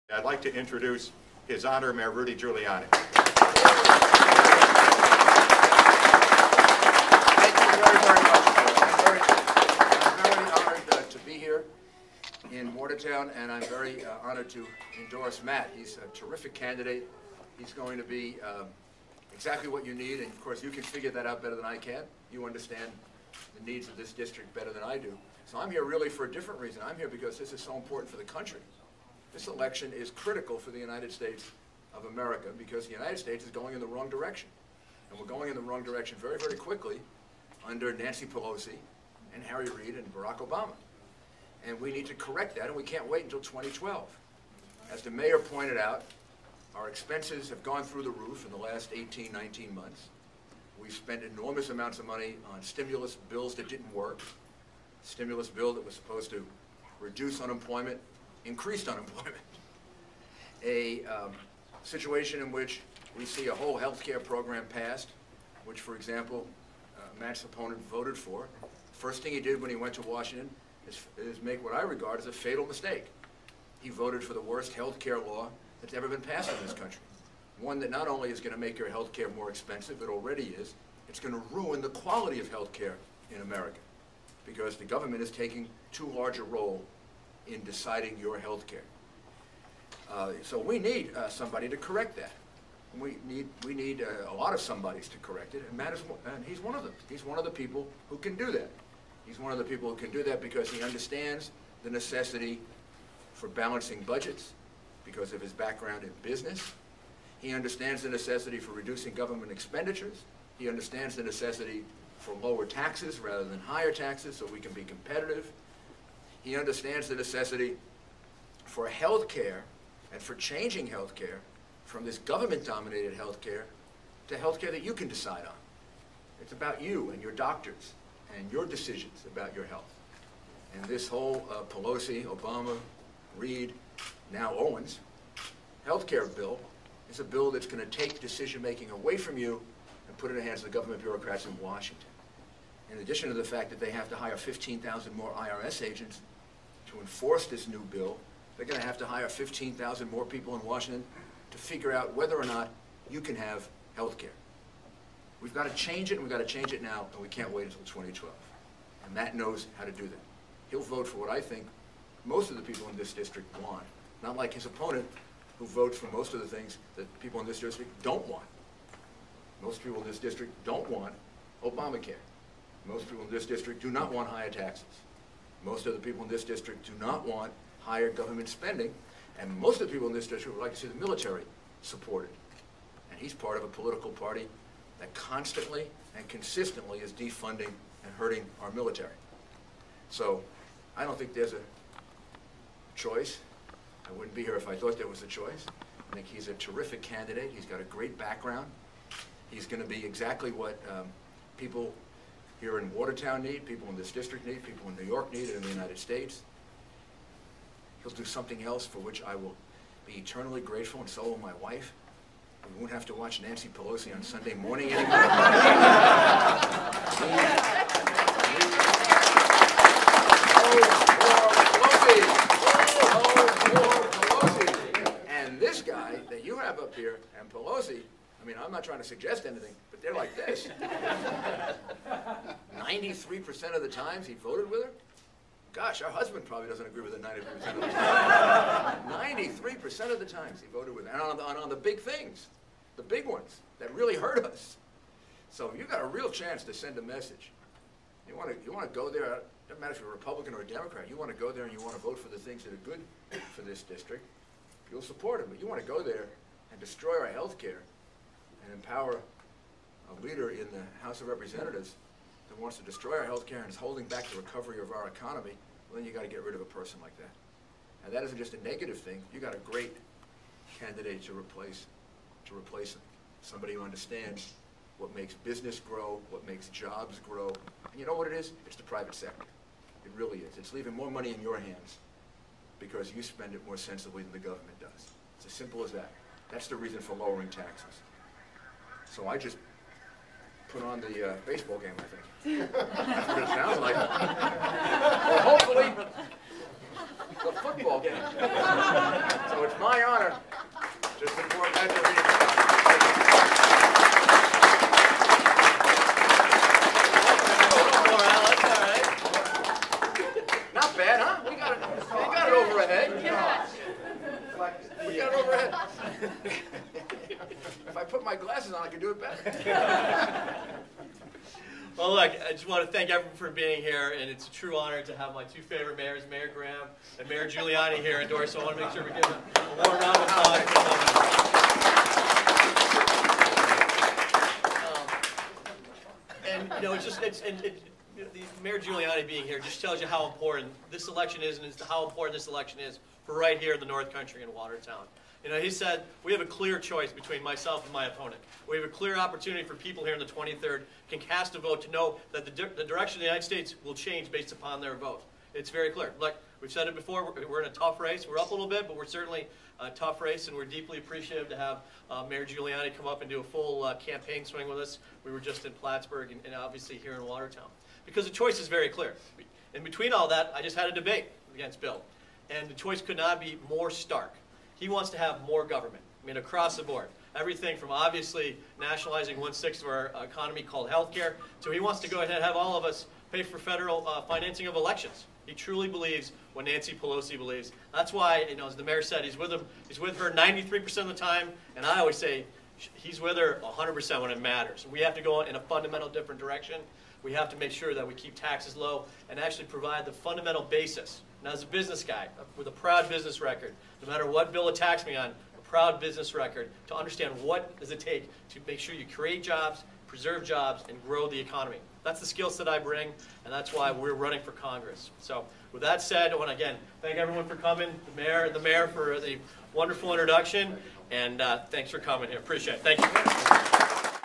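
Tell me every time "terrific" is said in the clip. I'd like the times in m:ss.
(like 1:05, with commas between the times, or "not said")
0:16, 3:16.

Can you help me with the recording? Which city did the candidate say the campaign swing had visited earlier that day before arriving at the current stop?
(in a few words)
Plattsburgh.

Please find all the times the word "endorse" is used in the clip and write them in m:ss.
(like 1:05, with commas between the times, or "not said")
0:15, 5:28.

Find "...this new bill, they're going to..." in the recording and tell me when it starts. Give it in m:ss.
2:27.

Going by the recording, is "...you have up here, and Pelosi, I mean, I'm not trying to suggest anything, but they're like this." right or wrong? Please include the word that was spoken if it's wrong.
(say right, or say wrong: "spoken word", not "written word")
right.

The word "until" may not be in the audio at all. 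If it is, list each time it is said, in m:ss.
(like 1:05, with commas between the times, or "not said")
0:43, 2:37.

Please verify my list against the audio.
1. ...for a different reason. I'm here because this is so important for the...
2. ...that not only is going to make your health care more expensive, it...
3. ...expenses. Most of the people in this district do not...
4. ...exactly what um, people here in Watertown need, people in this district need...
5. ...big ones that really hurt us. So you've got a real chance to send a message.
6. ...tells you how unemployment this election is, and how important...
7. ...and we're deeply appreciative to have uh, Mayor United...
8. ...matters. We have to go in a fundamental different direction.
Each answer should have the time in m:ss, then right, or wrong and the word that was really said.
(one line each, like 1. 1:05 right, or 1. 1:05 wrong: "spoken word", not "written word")
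1. 0:26 right
2. 1:17 right
3. 2:54 wrong: "taxes", not "expenses"
4. 3:20 right
5. 4:03 right
6. 5:39 wrong: "important", not "unemployment"
7. 6:00 wrong: "Giuliani", not "United"
8. 6:34 right.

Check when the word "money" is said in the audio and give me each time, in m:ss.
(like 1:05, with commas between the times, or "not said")
0:52, 4:41.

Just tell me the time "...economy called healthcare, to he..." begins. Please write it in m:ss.
6:20.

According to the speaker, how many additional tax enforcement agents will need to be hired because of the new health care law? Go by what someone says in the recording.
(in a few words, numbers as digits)
15,000.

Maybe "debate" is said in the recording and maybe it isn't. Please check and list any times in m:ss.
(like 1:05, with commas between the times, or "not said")
6:10.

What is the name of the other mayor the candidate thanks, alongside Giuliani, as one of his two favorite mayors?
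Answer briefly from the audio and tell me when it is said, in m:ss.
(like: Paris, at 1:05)
Mayor Graham, at 5:26.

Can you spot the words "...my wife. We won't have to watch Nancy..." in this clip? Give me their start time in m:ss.
3:31.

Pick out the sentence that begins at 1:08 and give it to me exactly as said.
First thing he did when he went to Washington is, is make what I regard as a fatal mistake.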